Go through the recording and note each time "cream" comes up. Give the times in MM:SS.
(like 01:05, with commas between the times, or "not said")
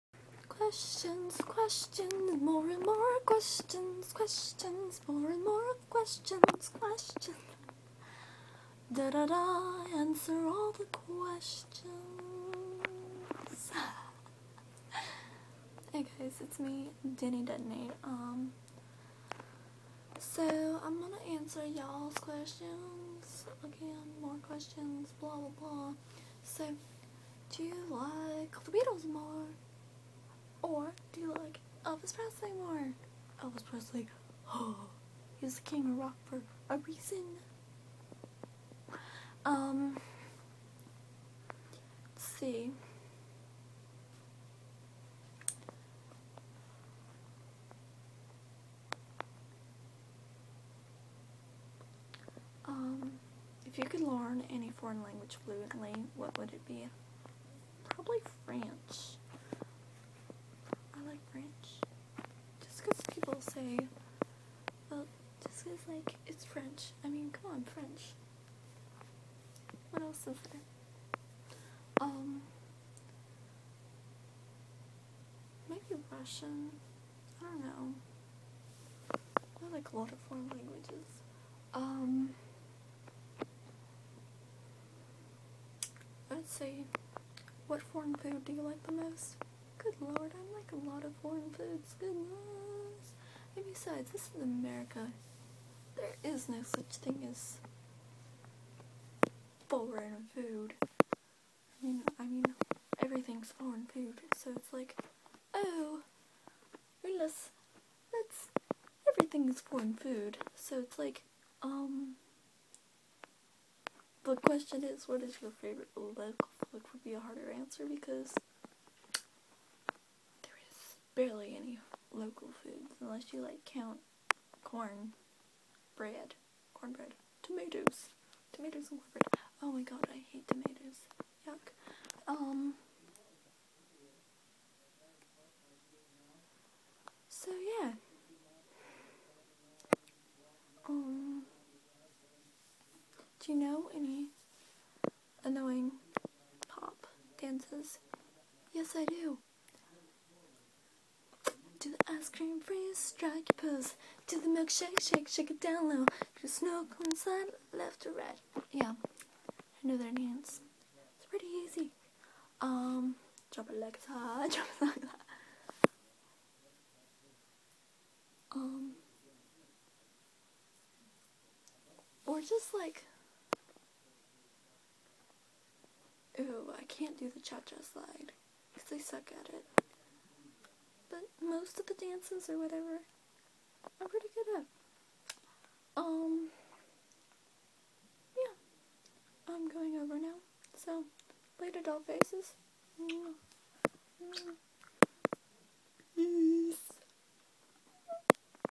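02:32.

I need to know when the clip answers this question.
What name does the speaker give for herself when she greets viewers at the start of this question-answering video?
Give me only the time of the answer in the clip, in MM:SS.
00:17.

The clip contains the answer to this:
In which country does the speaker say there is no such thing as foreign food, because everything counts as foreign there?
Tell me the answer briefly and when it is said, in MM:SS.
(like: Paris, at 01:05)
America, at 01:34.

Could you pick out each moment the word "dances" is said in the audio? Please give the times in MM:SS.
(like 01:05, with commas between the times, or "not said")
02:27, 02:40, 03:01.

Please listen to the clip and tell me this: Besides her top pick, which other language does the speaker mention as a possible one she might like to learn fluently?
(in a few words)
Russian.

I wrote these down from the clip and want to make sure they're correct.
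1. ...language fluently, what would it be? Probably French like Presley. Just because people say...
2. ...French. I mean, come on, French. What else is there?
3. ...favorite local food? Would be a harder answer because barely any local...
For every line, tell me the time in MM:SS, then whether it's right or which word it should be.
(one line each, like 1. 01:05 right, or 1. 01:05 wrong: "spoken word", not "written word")
1. 00:55 wrong: "French", not "Presley"
2. 01:06 right
3. 01:55 right.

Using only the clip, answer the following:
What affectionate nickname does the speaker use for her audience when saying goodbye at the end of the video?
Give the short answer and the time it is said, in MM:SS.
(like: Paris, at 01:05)
doll faces, at 03:11.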